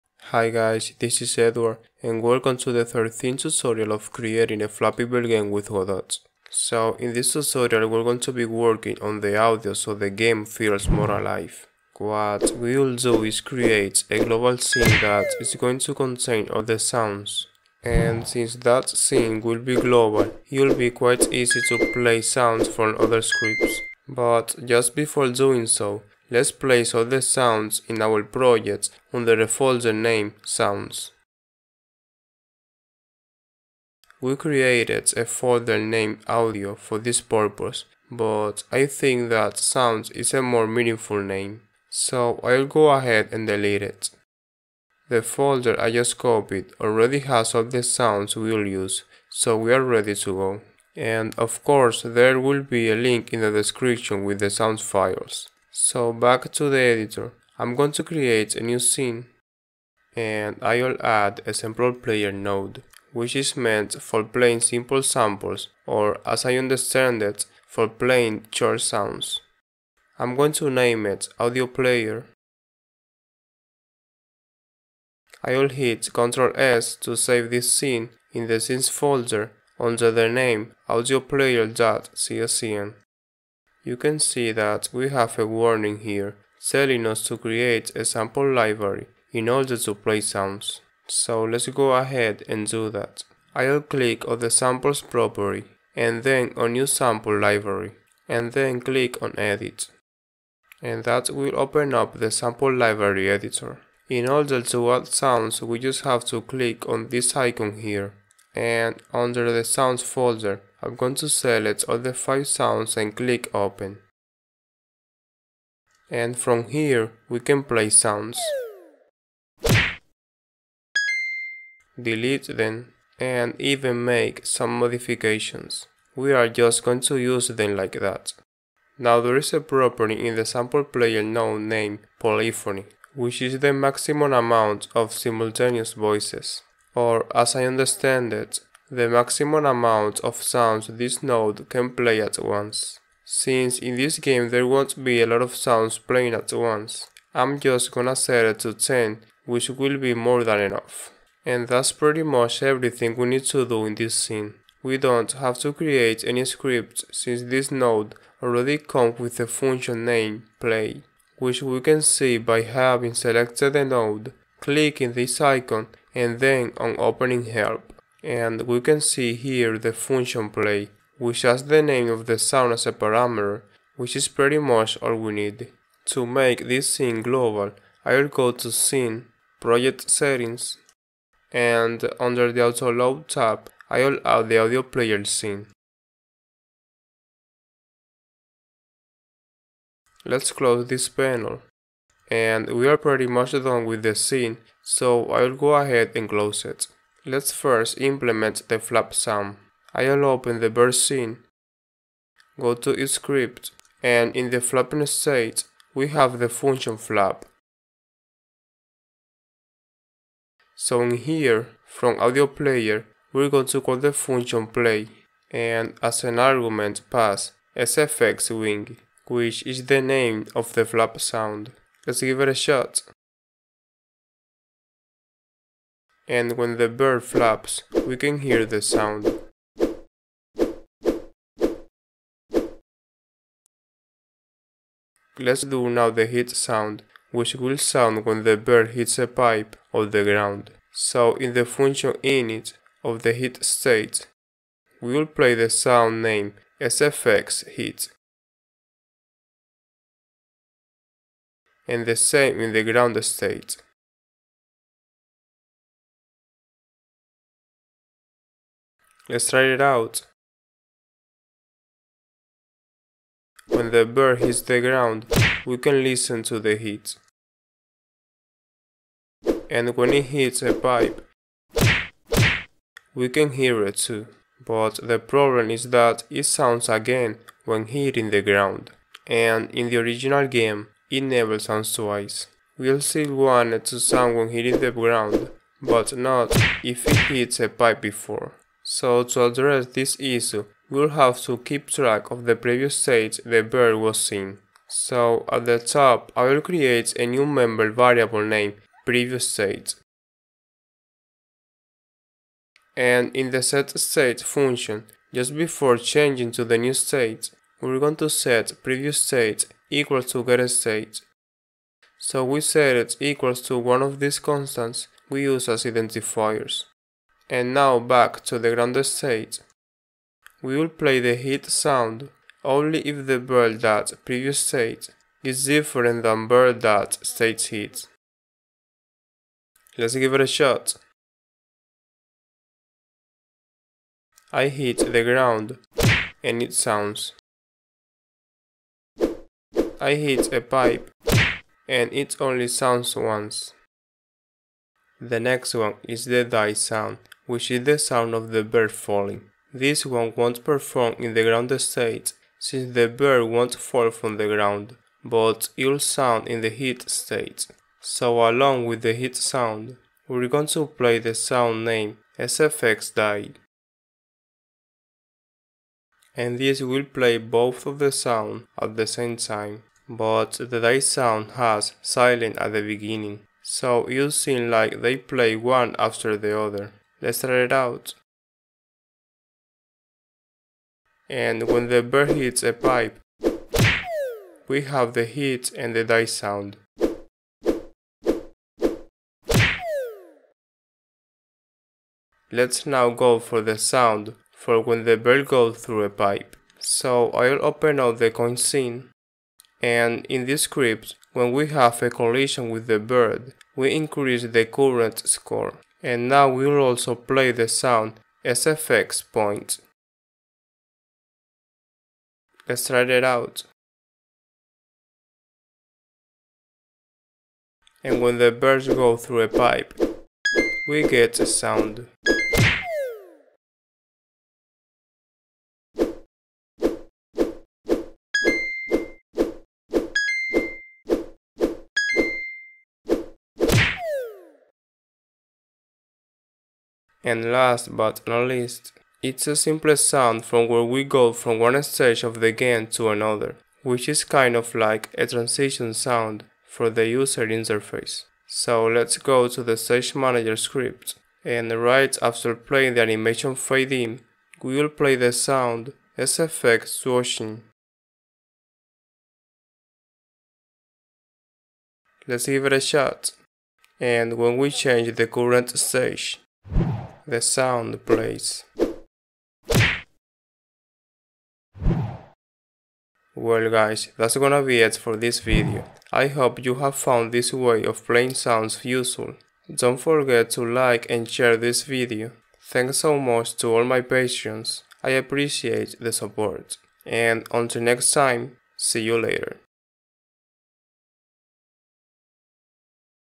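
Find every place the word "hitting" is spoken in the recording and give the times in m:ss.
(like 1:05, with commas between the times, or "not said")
4:37, 4:44.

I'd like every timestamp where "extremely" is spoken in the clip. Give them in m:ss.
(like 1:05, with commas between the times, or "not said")
not said.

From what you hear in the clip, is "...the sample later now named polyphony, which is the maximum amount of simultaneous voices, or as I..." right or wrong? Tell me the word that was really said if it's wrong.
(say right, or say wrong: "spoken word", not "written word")
wrong: "player", not "later".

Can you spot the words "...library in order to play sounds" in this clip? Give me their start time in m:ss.
1:28.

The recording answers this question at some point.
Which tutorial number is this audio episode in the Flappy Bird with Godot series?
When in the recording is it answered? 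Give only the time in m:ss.
0:02.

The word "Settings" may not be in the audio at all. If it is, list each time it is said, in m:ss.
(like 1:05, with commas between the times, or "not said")
3:00.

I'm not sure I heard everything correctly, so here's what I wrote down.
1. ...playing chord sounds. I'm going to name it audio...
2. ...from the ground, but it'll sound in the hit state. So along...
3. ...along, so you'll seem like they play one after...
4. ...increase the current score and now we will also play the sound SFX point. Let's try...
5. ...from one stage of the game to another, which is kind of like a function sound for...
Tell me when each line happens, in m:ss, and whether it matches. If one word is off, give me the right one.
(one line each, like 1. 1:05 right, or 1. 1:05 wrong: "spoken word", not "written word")
1. 1:07 right
2. 5:54 right
3. 6:12 wrong: "beginning", not "along"
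4. 6:43 right
5. 7:21 wrong: "transition", not "function".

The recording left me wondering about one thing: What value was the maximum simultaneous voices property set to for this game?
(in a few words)
10.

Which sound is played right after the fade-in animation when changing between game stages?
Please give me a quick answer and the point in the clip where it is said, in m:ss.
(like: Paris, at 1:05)
SFX swooshing, at 7:36.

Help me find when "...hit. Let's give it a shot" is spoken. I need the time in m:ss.
5:27.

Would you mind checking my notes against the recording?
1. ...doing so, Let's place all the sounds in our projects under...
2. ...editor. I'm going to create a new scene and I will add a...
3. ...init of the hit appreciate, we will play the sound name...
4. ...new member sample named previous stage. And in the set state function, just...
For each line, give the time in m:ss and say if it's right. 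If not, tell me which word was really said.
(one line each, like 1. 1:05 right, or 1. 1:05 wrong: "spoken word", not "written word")
1. 0:25 right
2. 0:56 right
3. 4:02 wrong: "state", not "appreciate"
4. 4:57 wrong: "variable", not "sample".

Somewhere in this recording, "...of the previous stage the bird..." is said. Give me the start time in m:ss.
4:52.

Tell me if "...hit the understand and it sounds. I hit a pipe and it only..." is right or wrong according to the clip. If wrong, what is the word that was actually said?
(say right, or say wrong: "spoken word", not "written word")
wrong: "ground", not "understand".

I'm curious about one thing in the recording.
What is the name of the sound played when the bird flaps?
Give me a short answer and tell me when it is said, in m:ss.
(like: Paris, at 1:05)
sfx wing, at 3:37.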